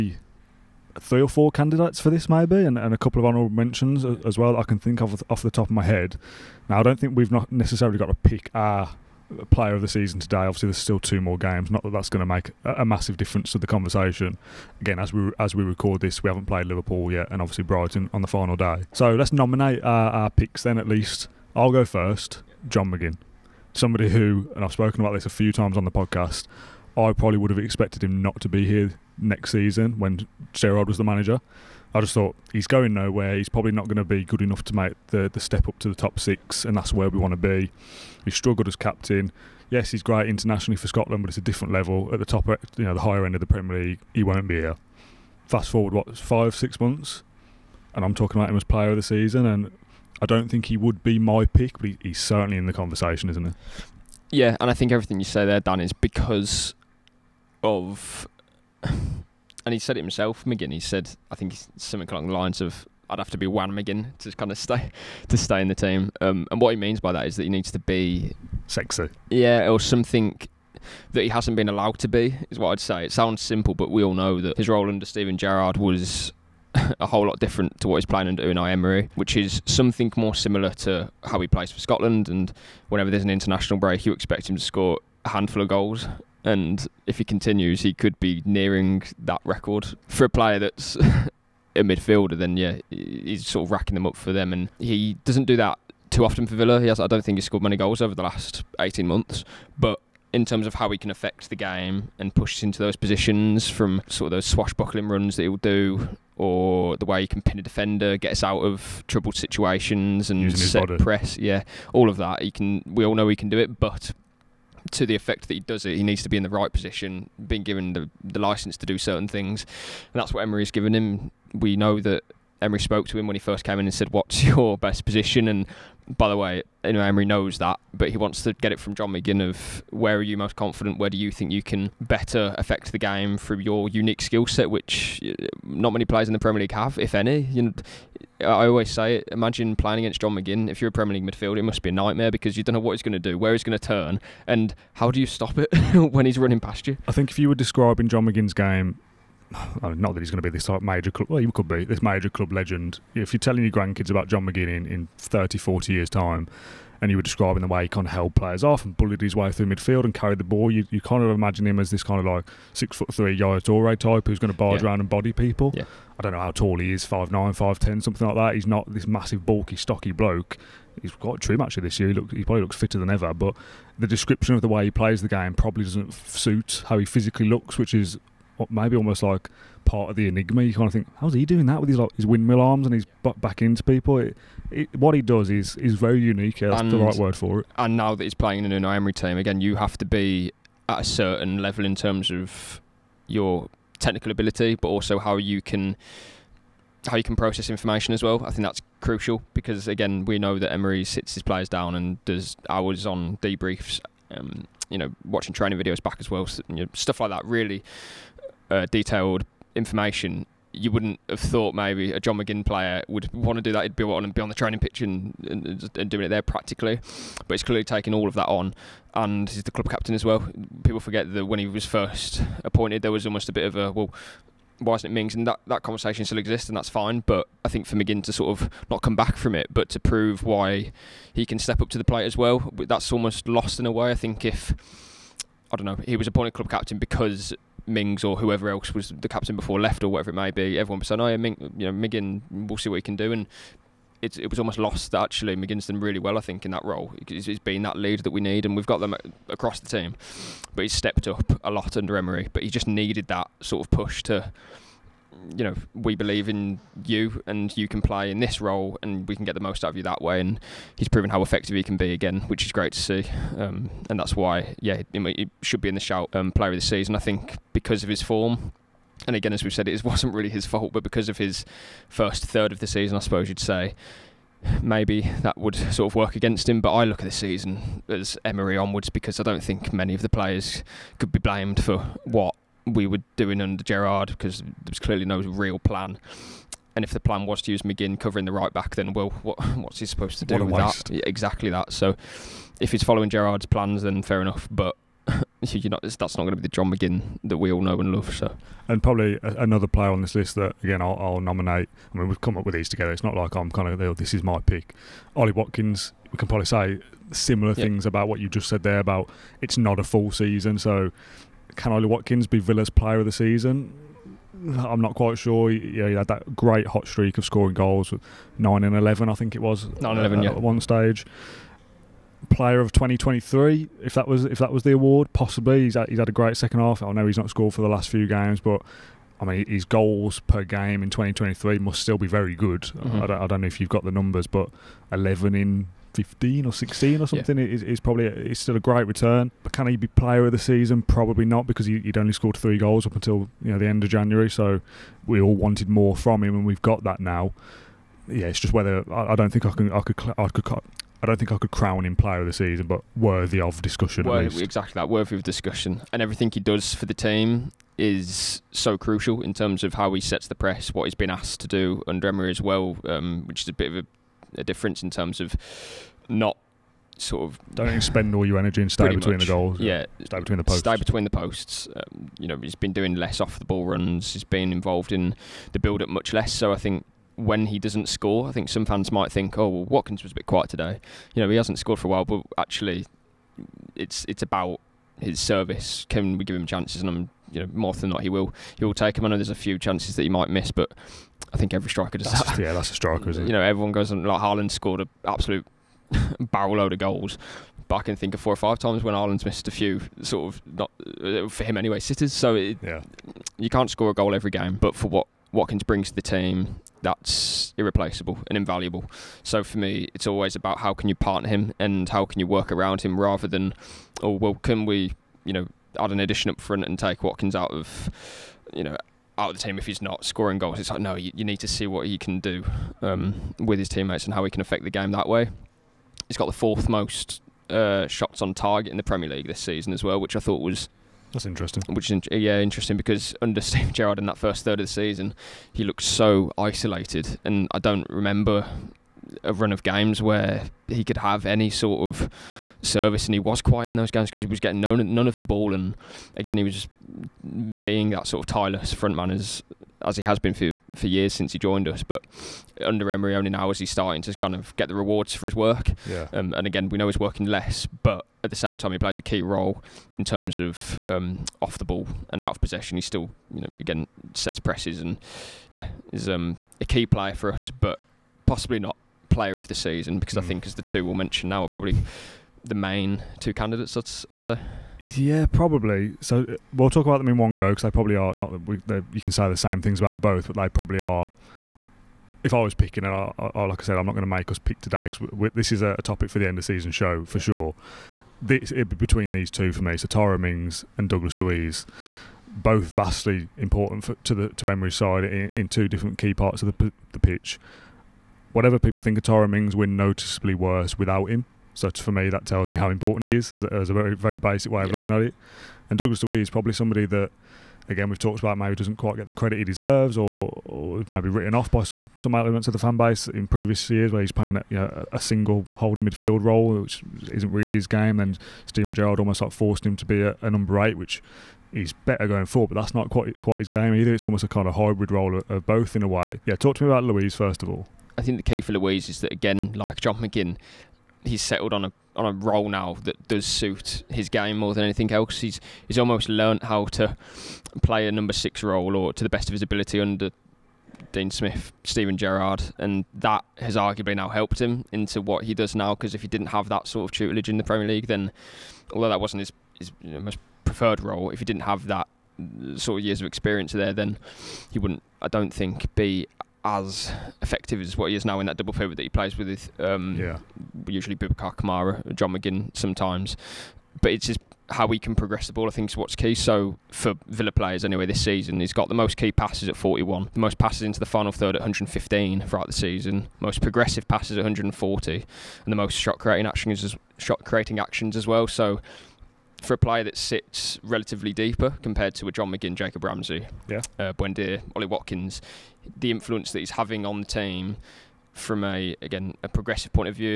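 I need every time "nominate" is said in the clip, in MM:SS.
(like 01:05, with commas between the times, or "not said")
00:19, 05:01.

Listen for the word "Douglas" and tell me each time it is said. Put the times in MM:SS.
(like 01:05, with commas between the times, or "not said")
08:11, 08:25.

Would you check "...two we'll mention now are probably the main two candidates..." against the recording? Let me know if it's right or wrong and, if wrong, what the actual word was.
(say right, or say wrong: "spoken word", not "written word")
right.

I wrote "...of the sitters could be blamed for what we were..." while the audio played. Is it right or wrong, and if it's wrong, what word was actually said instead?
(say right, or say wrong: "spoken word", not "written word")
wrong: "players", not "sitters".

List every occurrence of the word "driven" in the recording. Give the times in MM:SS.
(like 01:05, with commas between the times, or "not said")
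not said.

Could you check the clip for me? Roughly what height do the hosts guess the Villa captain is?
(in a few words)
5'9" to 5'10".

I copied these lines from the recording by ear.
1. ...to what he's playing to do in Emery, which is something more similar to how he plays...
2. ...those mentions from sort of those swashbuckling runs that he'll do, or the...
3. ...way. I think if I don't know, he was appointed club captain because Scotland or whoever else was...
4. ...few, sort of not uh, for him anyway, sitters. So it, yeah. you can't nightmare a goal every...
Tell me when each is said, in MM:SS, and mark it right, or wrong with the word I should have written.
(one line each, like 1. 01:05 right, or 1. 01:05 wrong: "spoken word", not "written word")
1. 01:17 right
2. 01:42 wrong: "positions", not "mentions"
3. 03:53 wrong: "Mings", not "Scotland"
4. 06:39 wrong: "score", not "nightmare".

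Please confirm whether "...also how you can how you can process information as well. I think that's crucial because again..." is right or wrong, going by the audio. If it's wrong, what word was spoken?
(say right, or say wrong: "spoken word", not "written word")
right.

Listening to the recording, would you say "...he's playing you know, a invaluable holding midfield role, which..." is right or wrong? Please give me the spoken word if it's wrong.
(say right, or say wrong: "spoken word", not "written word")
wrong: "single", not "invaluable".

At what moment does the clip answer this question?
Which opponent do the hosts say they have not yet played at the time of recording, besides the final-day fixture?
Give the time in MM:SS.
00:16.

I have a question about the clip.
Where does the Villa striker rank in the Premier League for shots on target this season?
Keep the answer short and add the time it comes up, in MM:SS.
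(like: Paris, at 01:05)
Fourth, at 07:06.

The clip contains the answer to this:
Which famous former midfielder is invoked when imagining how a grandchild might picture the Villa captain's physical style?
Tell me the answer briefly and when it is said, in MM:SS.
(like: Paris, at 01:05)
Yaya Toure, at 02:43.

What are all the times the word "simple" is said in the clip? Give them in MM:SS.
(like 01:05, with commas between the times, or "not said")
01:13.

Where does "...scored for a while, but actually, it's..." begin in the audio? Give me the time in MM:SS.
06:21.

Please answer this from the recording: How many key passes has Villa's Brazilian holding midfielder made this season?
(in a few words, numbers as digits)
41.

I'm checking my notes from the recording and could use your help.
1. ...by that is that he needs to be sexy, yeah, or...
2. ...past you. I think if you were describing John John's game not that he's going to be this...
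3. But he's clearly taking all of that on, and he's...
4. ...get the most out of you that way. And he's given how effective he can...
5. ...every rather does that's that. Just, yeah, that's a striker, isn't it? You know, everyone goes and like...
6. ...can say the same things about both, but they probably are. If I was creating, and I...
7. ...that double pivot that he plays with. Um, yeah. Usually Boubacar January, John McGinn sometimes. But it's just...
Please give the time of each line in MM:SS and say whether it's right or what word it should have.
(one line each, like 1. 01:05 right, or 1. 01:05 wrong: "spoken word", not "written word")
1. 01:06 right
2. 02:26 wrong: "McGinn", not "John"
3. 03:37 right
4. 04:19 wrong: "proven", not "given"
5. 06:31 wrong: "striker", not "rather"
6. 07:59 wrong: "picking", not "creating"
7. 09:18 wrong: "Kamara", not "January".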